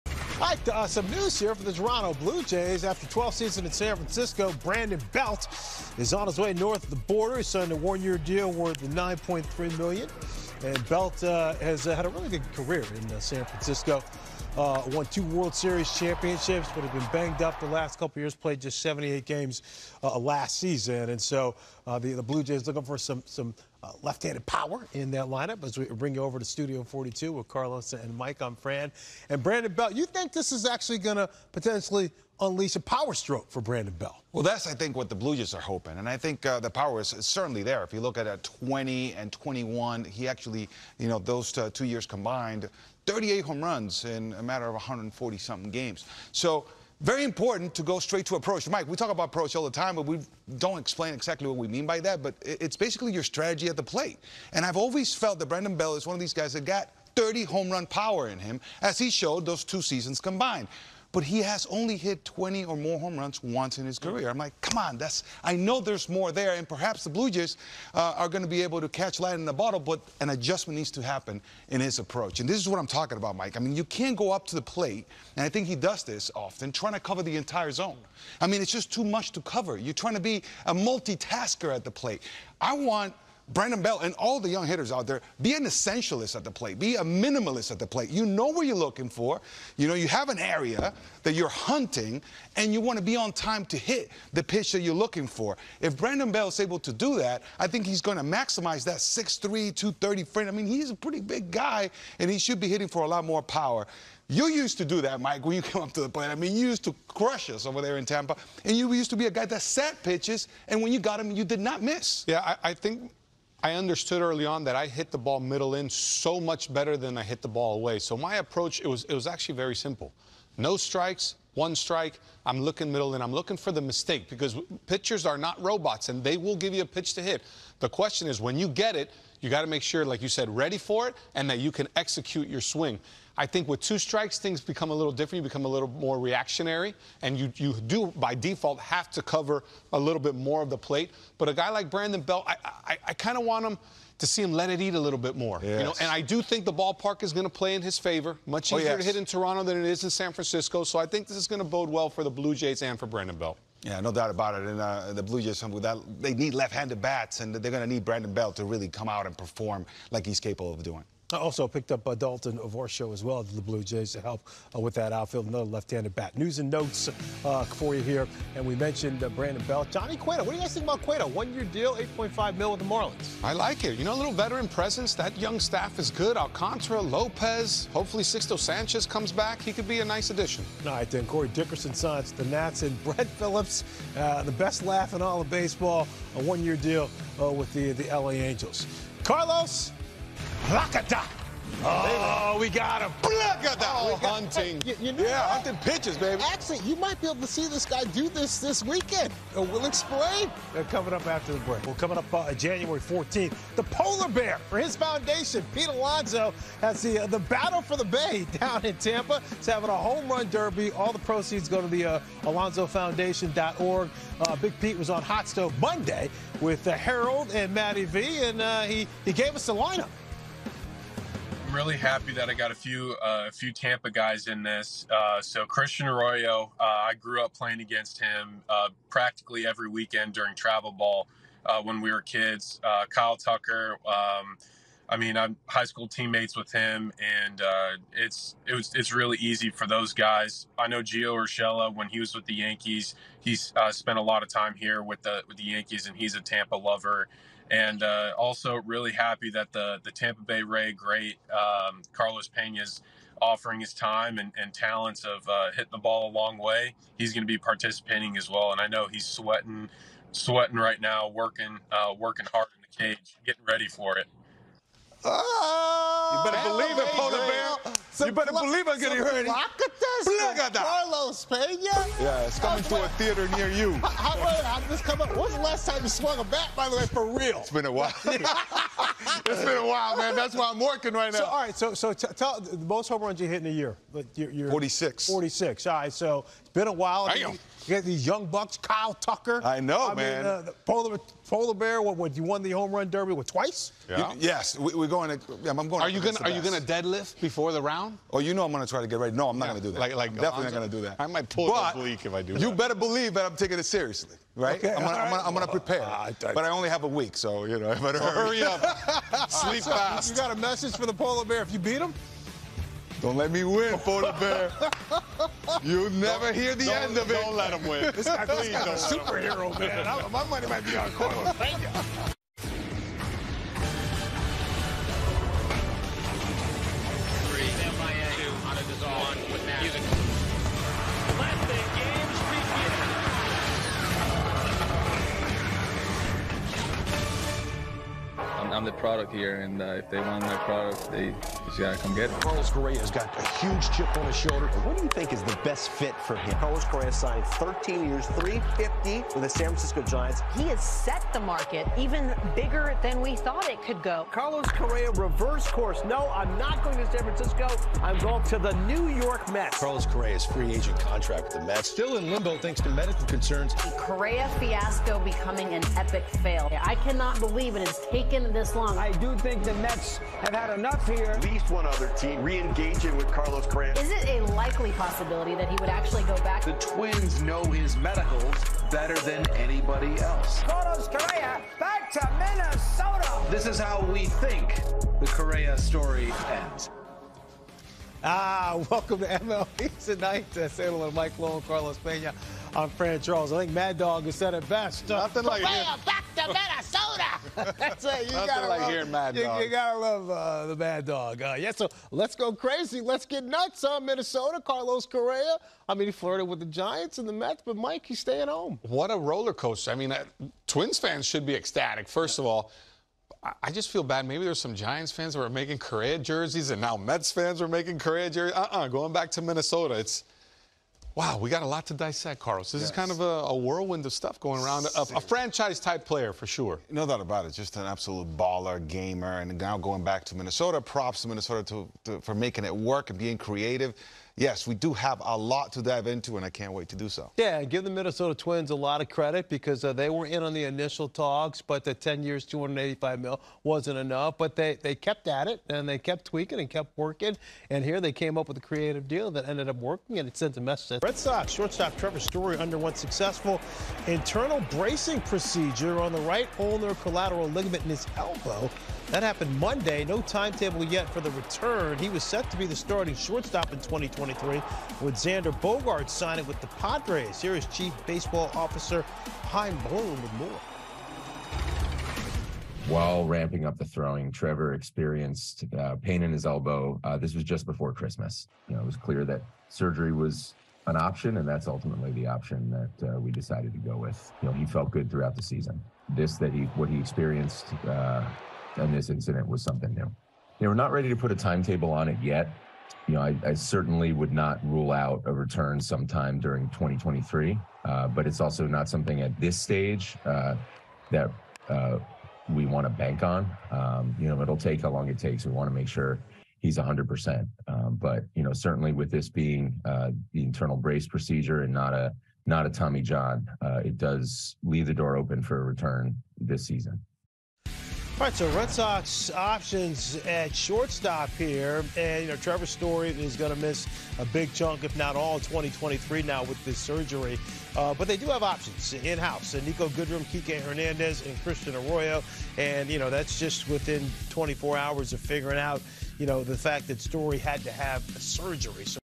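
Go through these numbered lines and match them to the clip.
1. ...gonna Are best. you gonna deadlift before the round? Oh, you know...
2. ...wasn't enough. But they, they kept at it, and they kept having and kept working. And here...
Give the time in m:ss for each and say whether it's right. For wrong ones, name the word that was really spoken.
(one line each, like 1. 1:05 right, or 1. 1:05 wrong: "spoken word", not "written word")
1. 4:56 right
2. 7:23 wrong: "tweaking", not "having".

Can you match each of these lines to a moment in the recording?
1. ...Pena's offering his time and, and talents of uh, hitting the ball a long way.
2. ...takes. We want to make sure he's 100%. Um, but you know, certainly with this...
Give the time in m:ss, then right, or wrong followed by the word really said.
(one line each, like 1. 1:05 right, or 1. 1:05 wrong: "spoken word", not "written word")
1. 4:12 right
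2. 8:25 right.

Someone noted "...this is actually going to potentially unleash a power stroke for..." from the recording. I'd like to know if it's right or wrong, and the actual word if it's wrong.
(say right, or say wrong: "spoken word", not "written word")
right.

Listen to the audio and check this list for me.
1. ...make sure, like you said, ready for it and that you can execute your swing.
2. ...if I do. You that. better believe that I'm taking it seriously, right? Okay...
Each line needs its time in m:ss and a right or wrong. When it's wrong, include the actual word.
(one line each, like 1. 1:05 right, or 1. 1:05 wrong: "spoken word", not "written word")
1. 2:09 right
2. 5:02 right.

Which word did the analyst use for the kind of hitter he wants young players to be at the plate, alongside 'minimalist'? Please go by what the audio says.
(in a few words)
essentialist.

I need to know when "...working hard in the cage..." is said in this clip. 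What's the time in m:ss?
4:22.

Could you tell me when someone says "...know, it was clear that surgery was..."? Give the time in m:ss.
7:58.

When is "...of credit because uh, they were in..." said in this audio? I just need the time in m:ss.
7:19.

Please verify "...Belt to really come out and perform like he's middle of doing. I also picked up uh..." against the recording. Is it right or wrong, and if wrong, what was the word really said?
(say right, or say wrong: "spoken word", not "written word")
wrong: "capable", not "middle".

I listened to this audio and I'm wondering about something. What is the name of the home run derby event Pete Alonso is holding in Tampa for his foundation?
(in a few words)
Battle for the Bay.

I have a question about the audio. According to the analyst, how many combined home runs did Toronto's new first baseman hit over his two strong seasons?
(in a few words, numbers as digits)
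38.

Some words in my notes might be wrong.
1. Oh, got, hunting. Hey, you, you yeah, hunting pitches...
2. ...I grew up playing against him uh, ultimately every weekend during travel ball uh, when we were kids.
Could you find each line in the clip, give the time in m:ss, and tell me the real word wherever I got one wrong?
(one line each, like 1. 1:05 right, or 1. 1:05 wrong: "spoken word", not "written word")
1. 3:13 right
2. 3:46 wrong: "practically", not "ultimately".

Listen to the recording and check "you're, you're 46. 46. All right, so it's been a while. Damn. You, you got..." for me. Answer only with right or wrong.
right.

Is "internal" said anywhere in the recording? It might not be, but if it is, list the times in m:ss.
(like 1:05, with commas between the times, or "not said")
7:34, 8:30.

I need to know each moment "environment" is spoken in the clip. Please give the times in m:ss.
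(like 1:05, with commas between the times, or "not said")
not said.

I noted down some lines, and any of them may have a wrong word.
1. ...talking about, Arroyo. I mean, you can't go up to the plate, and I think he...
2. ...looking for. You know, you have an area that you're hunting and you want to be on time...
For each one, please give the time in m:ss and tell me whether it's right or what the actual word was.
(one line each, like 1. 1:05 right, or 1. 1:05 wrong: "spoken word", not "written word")
1. 1:12 wrong: "Mike", not "Arroyo"
2. 1:28 right.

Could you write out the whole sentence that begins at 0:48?
Mike, we talk about approach all the time, but we don't explain exactly what we mean by that.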